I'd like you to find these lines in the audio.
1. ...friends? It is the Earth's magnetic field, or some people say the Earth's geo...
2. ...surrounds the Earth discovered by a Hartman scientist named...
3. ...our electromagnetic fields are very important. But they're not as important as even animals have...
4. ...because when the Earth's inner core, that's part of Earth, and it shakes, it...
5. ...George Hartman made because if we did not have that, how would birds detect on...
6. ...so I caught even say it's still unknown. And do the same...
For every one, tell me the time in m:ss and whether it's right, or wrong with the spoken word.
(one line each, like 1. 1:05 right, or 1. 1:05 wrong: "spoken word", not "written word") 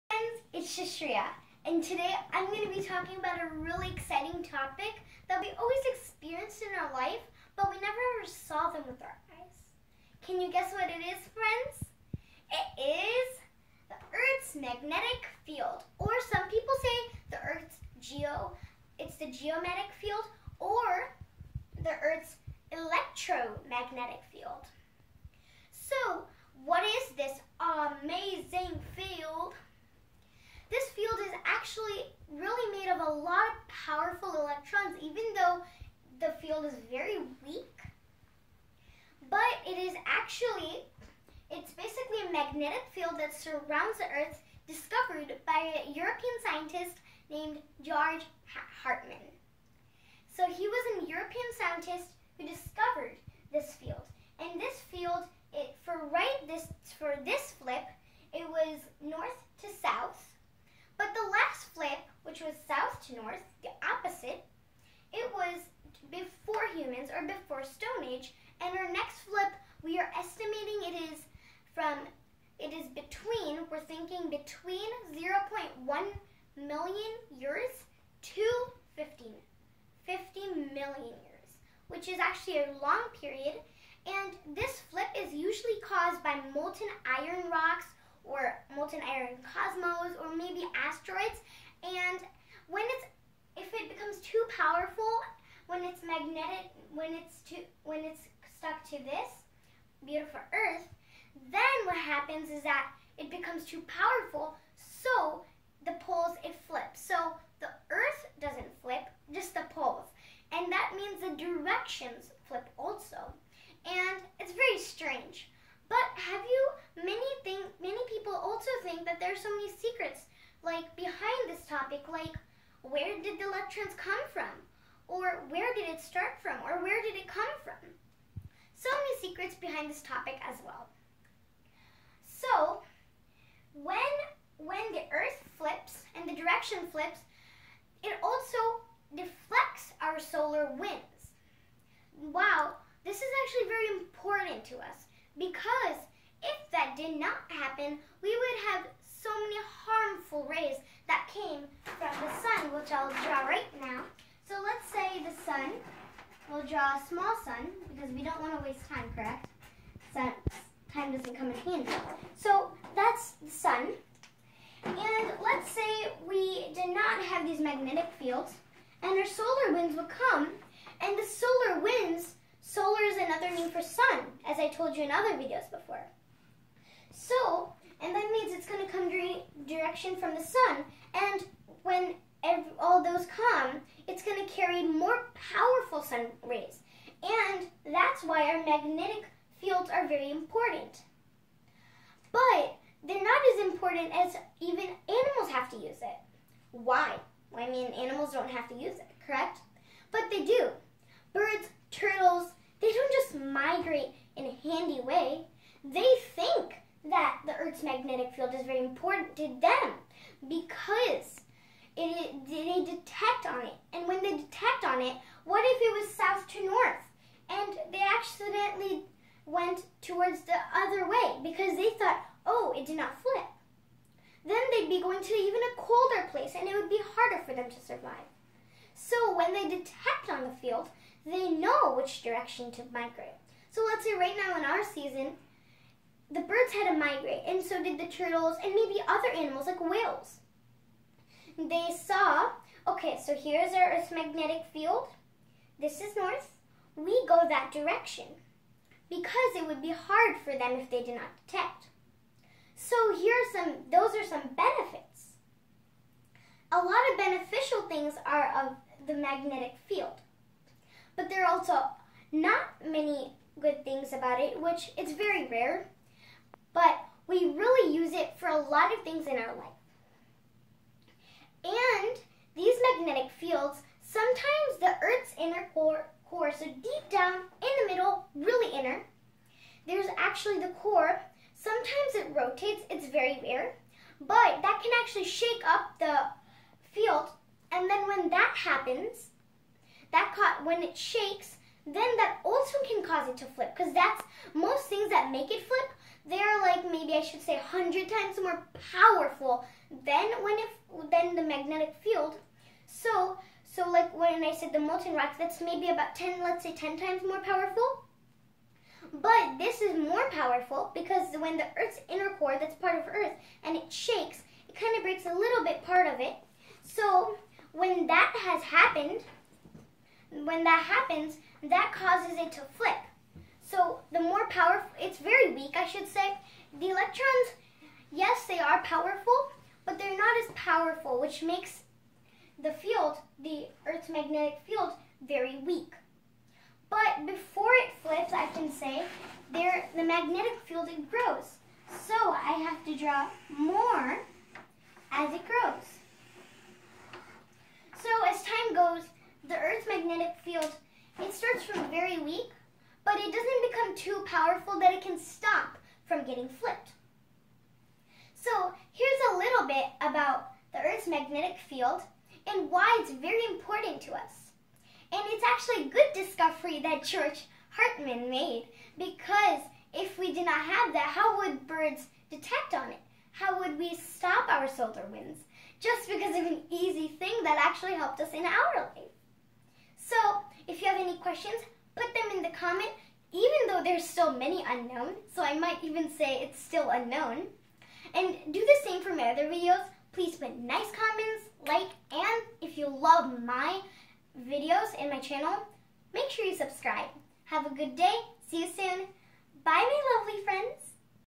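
1. 0:11 right
2. 0:43 wrong: "European", not "Hartman"
3. 3:08 wrong: "magnetic", not "electromagnetic"
4. 5:10 right
5. 6:07 right
6. 6:25 wrong: "might", not "caught".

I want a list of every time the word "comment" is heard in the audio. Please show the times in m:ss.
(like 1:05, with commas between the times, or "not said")
6:22, 6:30.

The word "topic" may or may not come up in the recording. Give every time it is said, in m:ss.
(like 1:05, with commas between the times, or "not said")
0:04, 2:01, 2:10.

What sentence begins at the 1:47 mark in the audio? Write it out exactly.
So the earth doesn't flip, just the poles.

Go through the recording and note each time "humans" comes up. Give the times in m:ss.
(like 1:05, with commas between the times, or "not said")
1:06.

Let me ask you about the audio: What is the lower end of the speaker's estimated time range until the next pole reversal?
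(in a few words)
0.1 million years.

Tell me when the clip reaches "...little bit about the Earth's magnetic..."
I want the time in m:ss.
5:59.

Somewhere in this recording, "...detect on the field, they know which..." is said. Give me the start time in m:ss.
3:49.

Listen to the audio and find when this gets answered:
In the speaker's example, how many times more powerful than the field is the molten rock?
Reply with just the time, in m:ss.
5:06.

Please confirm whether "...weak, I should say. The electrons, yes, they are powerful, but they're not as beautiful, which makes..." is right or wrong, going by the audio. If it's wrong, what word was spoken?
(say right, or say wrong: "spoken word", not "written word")
wrong: "powerful", not "beautiful".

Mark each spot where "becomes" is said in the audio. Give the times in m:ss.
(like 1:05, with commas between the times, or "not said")
1:33, 1:43, 5:53.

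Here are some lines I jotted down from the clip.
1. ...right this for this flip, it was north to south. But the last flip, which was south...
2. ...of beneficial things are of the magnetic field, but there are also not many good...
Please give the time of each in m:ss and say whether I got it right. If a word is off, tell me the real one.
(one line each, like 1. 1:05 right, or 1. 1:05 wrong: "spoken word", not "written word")
1. 0:56 right
2. 4:17 right.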